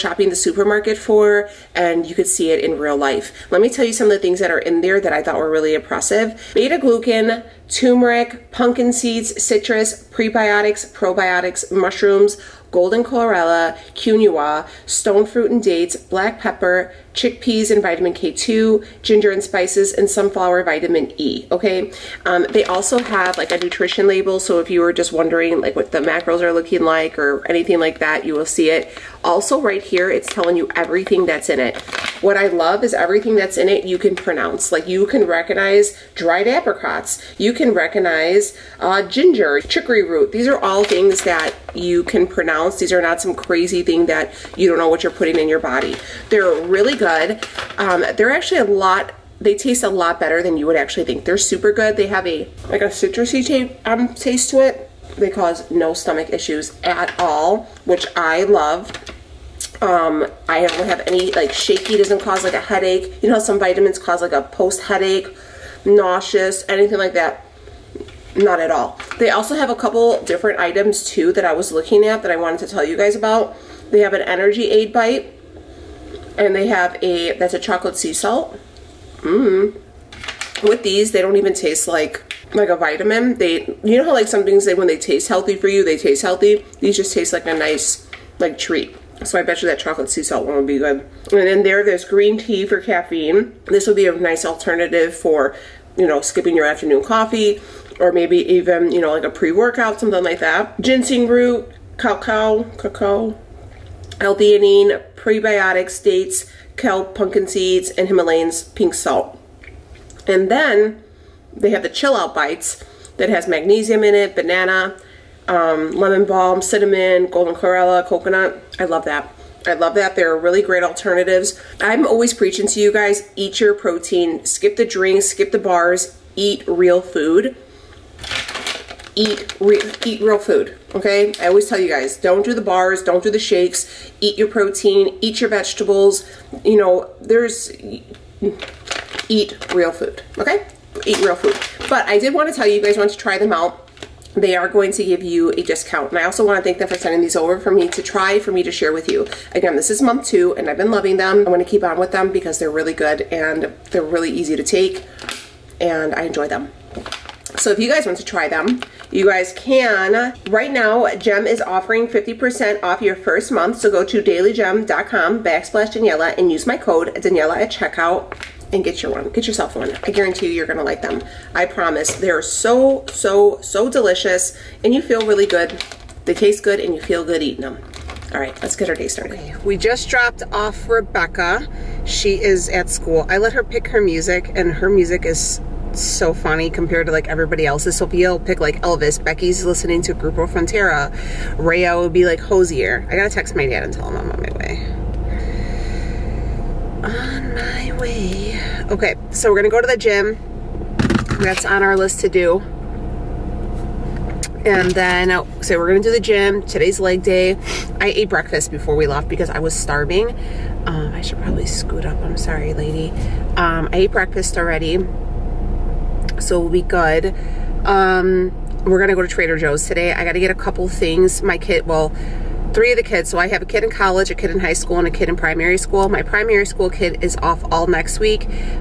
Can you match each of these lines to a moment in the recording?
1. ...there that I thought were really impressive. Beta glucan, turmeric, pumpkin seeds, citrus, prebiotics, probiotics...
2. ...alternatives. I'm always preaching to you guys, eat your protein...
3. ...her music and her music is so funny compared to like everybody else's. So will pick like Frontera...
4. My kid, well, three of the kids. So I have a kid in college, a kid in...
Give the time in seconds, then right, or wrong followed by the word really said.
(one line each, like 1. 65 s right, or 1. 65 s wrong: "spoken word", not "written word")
1. 4 s right
2. 120 s right
3. 183 s wrong: "Elvis", not "Frontera"
4. 221 s right.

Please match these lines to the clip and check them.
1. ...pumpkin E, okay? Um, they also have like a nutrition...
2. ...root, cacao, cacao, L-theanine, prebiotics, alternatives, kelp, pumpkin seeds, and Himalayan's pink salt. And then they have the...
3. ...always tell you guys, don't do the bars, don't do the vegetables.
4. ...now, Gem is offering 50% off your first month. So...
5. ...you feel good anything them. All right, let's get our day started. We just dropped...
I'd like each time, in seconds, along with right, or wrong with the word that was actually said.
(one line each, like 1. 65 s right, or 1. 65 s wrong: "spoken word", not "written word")
1. 20 s wrong: "vitamin", not "pumpkin"
2. 101 s wrong: "dates", not "alternatives"
3. 131 s wrong: "shakes", not "vegetables"
4. 160 s right
5. 176 s wrong: "eating", not "anything".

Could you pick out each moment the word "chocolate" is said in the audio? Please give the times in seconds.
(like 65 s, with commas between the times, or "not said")
77 s, 89 s.